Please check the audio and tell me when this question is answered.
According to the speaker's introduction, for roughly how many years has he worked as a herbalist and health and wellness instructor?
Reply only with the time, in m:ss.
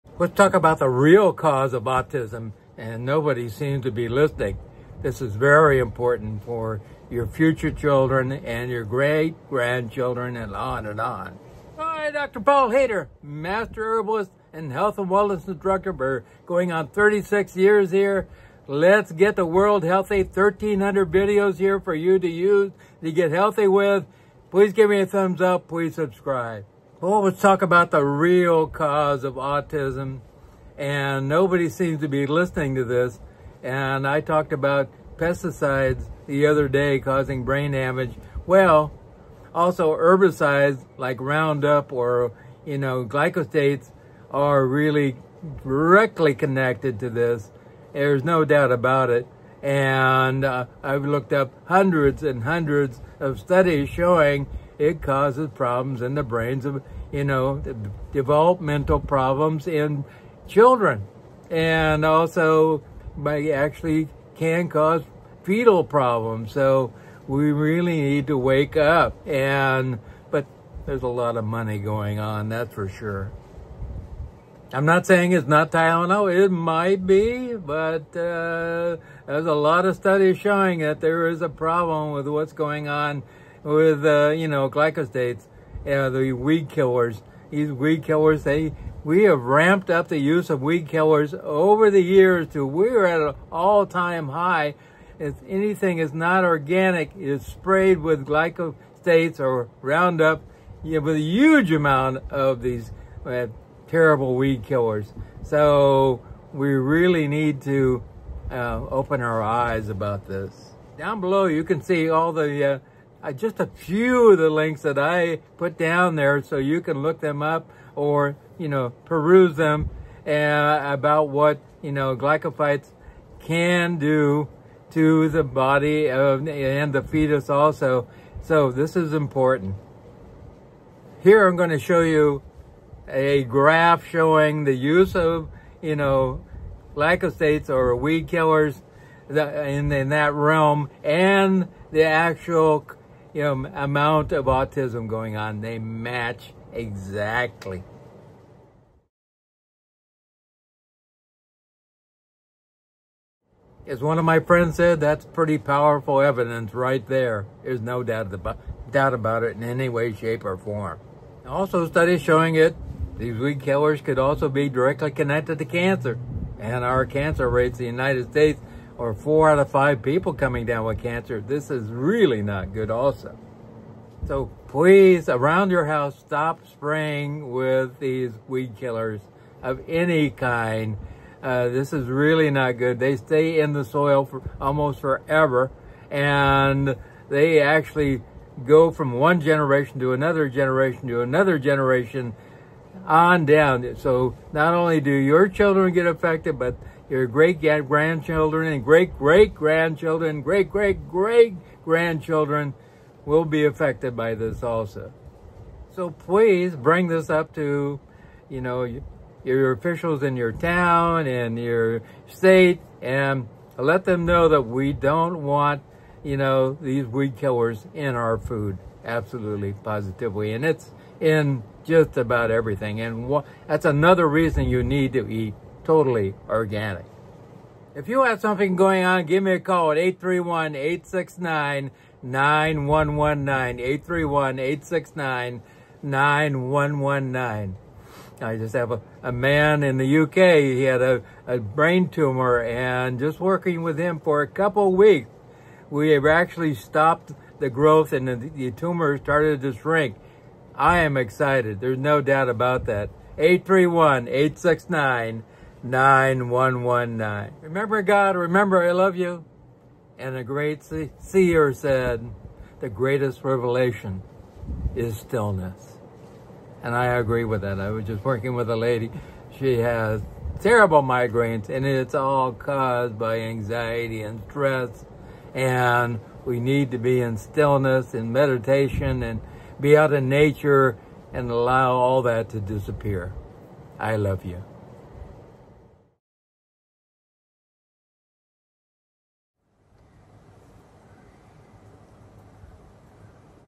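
0:16.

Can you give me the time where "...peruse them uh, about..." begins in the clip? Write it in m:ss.
1:59.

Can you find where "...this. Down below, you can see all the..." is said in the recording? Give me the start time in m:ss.
1:50.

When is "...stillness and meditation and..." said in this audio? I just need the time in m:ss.
4:37.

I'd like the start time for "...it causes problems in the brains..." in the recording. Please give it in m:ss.
0:54.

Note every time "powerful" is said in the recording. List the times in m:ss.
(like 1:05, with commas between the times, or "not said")
2:35.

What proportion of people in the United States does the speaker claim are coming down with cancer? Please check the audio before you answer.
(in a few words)
4 out of 5.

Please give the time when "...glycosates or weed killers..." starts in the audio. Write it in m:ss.
2:16.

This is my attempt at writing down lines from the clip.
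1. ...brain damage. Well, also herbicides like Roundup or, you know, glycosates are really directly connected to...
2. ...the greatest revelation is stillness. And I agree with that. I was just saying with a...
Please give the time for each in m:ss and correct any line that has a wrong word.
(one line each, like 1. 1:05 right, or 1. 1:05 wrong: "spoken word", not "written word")
1. 0:37 right
2. 4:22 wrong: "working", not "saying".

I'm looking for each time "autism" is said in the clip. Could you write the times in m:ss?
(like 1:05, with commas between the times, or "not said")
0:01, 0:29, 2:24.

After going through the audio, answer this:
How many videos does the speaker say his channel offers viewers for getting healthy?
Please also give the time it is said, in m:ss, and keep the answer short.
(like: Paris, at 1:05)
1,300, at 0:20.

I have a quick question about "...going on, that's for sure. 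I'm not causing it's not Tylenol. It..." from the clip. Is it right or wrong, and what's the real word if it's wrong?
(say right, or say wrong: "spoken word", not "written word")
wrong: "saying", not "causing".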